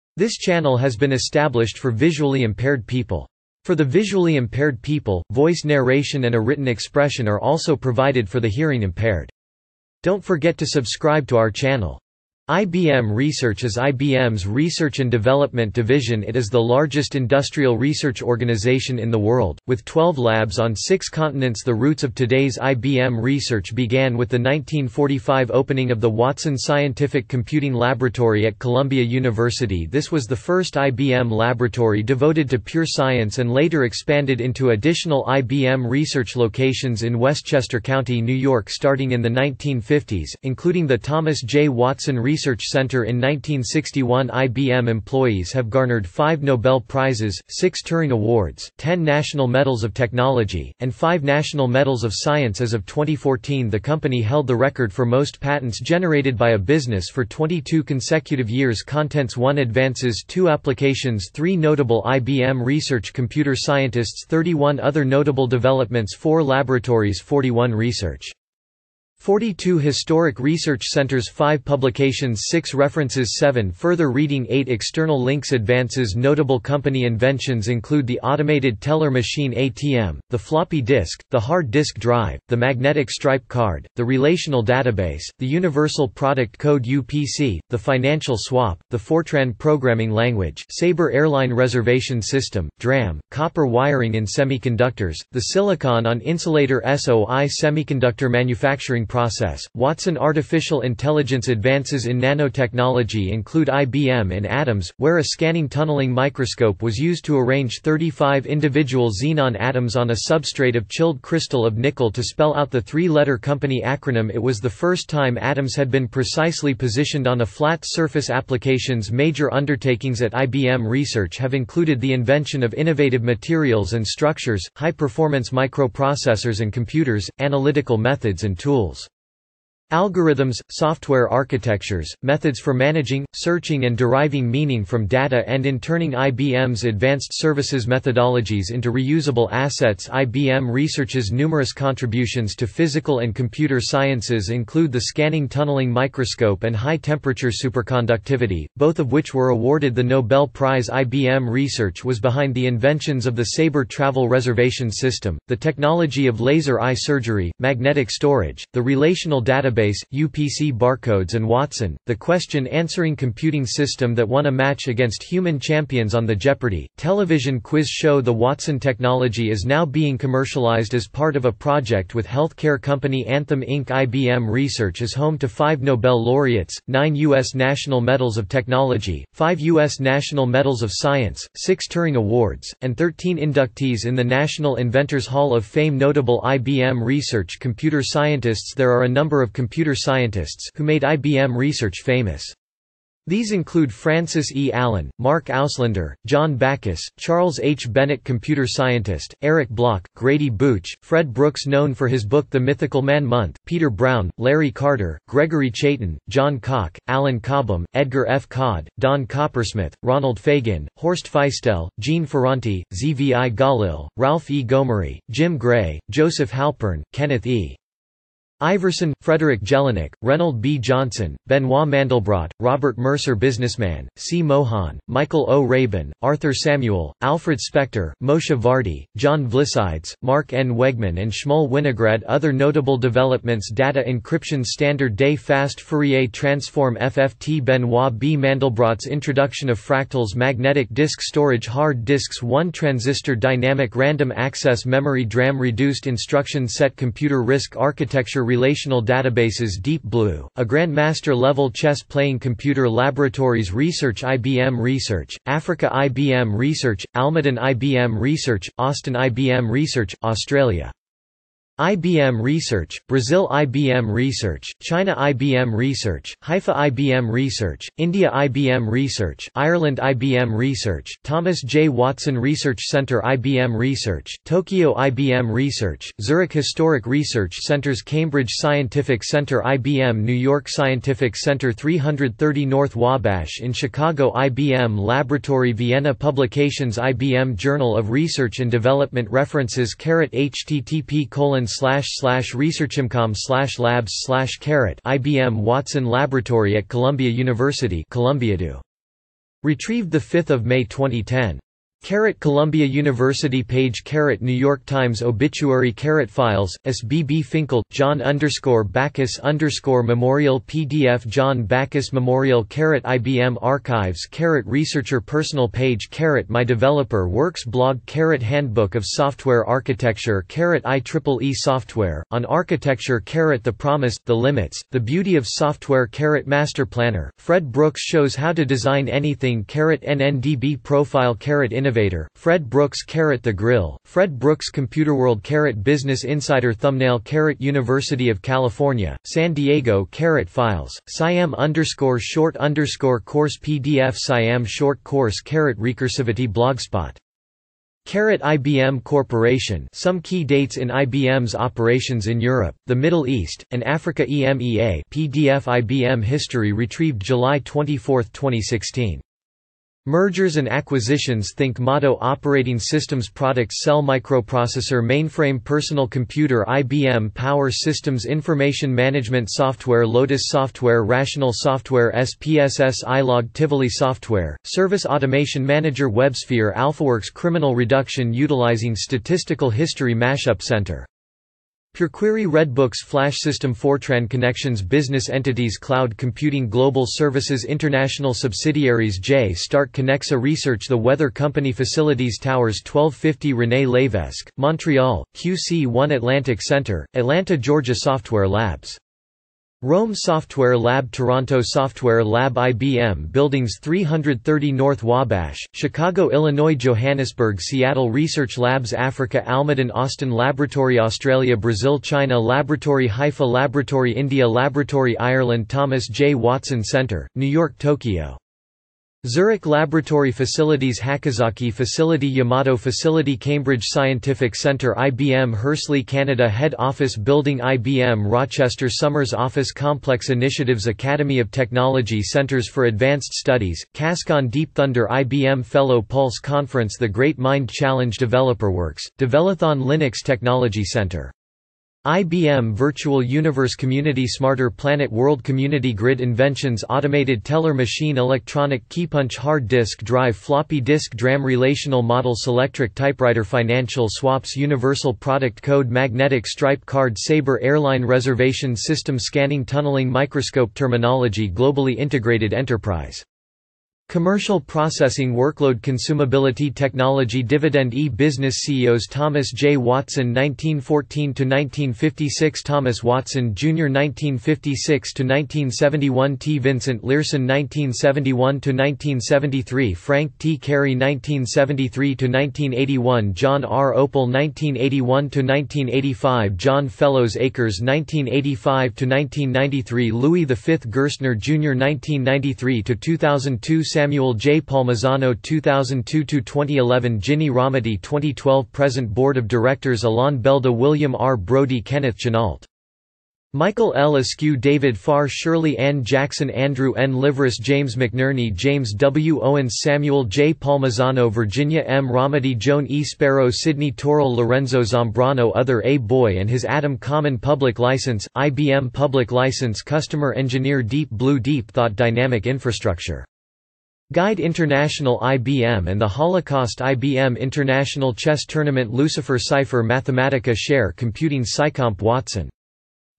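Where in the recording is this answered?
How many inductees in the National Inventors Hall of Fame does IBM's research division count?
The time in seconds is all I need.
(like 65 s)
182 s.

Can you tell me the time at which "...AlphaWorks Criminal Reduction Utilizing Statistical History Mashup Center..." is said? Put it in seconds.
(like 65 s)
376 s.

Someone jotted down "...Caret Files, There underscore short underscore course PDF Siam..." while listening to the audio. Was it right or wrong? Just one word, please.
wrong.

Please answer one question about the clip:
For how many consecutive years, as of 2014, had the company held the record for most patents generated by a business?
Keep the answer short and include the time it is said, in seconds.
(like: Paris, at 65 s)
22, at 57 s.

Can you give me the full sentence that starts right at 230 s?
Wegman and Shmuel Winograd Other notable developments Data encryption standard day fast Fourier transform FFT Benoit B.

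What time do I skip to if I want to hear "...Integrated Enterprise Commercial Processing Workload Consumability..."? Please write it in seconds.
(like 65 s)
461 s.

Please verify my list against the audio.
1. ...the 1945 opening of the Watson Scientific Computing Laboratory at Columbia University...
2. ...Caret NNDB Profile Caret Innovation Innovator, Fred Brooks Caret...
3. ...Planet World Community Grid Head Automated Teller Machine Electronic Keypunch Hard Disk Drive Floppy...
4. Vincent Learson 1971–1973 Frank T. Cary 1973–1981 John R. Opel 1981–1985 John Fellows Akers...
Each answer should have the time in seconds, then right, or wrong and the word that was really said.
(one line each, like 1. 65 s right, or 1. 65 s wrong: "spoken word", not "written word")
1. 24 s right
2. 329 s right
3. 444 s wrong: "Inventions", not "Head"
4. 476 s right.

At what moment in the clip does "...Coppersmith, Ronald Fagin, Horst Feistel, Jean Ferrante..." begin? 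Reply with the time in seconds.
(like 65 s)
209 s.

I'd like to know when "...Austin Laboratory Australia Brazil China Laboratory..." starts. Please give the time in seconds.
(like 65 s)
409 s.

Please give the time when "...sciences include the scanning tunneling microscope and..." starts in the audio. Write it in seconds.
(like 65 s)
143 s.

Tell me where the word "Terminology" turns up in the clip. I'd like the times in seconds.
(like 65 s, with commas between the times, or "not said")
460 s.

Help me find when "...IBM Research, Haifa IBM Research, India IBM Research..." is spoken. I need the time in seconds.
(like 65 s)
265 s.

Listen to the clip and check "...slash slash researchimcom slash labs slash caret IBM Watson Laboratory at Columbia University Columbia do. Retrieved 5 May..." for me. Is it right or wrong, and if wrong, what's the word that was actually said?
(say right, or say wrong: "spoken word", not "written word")
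right.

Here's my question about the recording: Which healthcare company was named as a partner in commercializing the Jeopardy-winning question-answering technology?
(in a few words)
Anthem Inc.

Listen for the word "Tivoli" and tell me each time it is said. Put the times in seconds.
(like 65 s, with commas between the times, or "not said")
373 s.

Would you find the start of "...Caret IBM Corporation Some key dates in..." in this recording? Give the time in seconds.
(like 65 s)
348 s.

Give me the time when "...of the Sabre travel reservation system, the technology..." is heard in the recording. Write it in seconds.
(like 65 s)
153 s.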